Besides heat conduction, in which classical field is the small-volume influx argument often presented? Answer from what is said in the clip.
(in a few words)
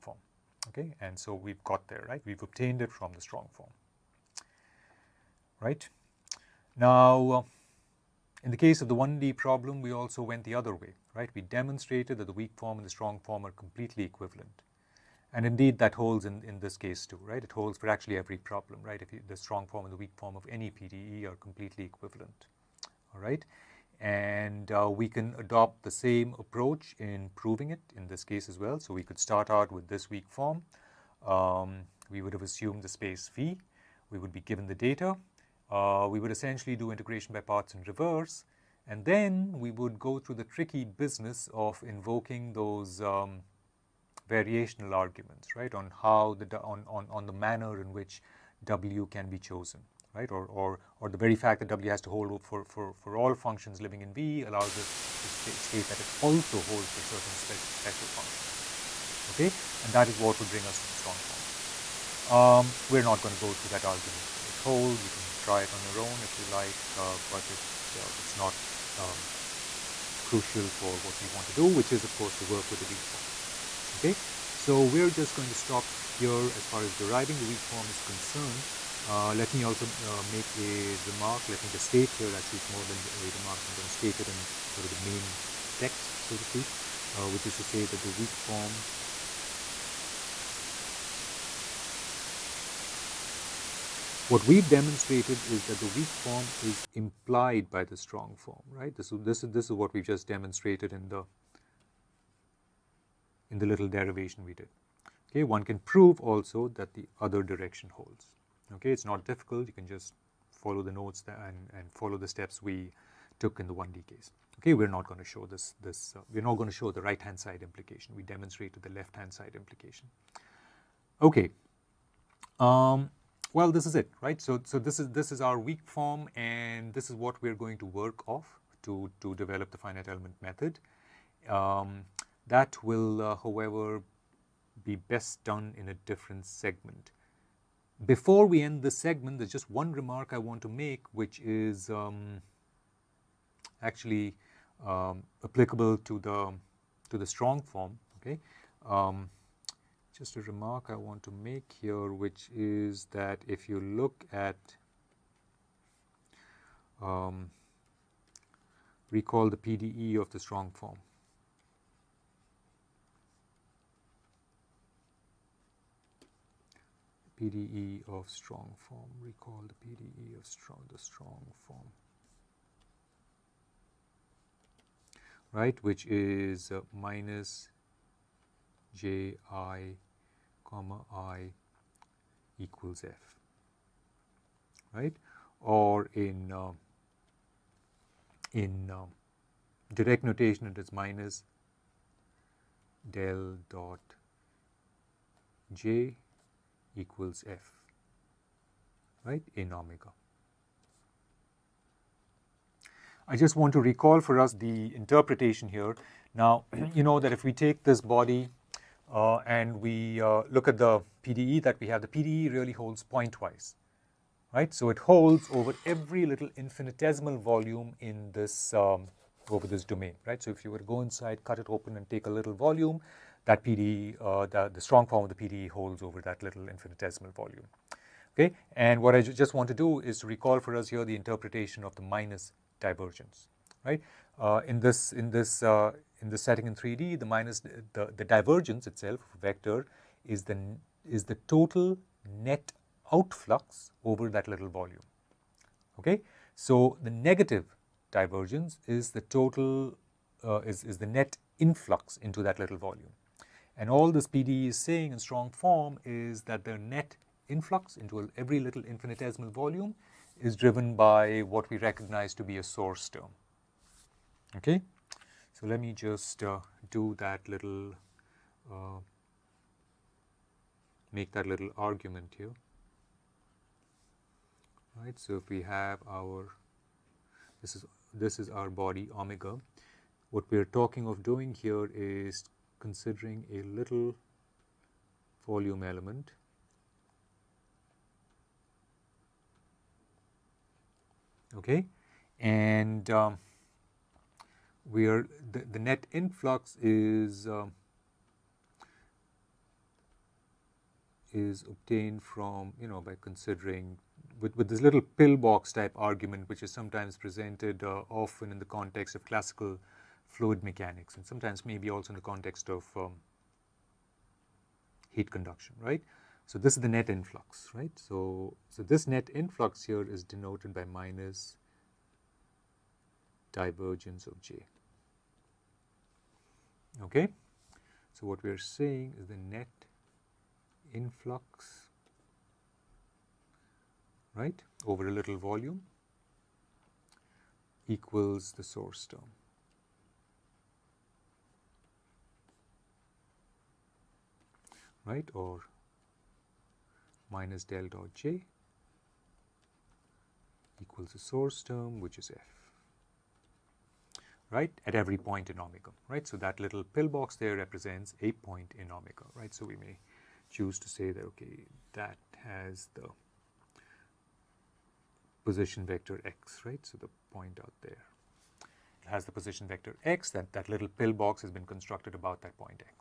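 Fluid mechanics.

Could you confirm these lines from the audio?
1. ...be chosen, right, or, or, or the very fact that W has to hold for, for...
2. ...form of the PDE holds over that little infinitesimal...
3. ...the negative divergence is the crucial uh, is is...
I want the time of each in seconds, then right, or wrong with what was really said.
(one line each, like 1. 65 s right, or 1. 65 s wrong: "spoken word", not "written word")
1. 49 s right
2. 225 s right
3. 247 s wrong: "total", not "crucial".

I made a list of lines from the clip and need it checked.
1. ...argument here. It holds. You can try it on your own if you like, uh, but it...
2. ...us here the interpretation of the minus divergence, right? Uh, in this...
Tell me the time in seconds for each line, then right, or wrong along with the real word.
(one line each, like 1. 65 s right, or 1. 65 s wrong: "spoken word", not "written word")
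1. 63 s right
2. 230 s right.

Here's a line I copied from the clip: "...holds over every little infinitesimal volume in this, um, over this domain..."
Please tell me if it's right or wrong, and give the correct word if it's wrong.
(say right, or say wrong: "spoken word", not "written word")
right.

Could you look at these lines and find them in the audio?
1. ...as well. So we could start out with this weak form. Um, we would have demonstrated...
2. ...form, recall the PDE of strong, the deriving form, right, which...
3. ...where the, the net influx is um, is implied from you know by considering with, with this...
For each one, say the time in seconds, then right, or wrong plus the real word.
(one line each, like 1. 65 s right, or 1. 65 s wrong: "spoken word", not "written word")
1. 28 s wrong: "assumed", not "demonstrated"
2. 168 s wrong: "strong", not "deriving"
3. 294 s wrong: "obtained", not "implied".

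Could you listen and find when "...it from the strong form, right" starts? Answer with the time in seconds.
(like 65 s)
2 s.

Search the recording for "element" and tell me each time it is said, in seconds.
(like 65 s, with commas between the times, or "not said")
130 s, 285 s.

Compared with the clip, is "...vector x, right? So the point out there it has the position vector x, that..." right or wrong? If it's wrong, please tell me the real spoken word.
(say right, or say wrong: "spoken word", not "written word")
right.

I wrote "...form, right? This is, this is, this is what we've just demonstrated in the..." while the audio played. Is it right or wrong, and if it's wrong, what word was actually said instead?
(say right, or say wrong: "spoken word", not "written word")
right.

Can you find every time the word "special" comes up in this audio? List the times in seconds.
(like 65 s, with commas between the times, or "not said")
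57 s.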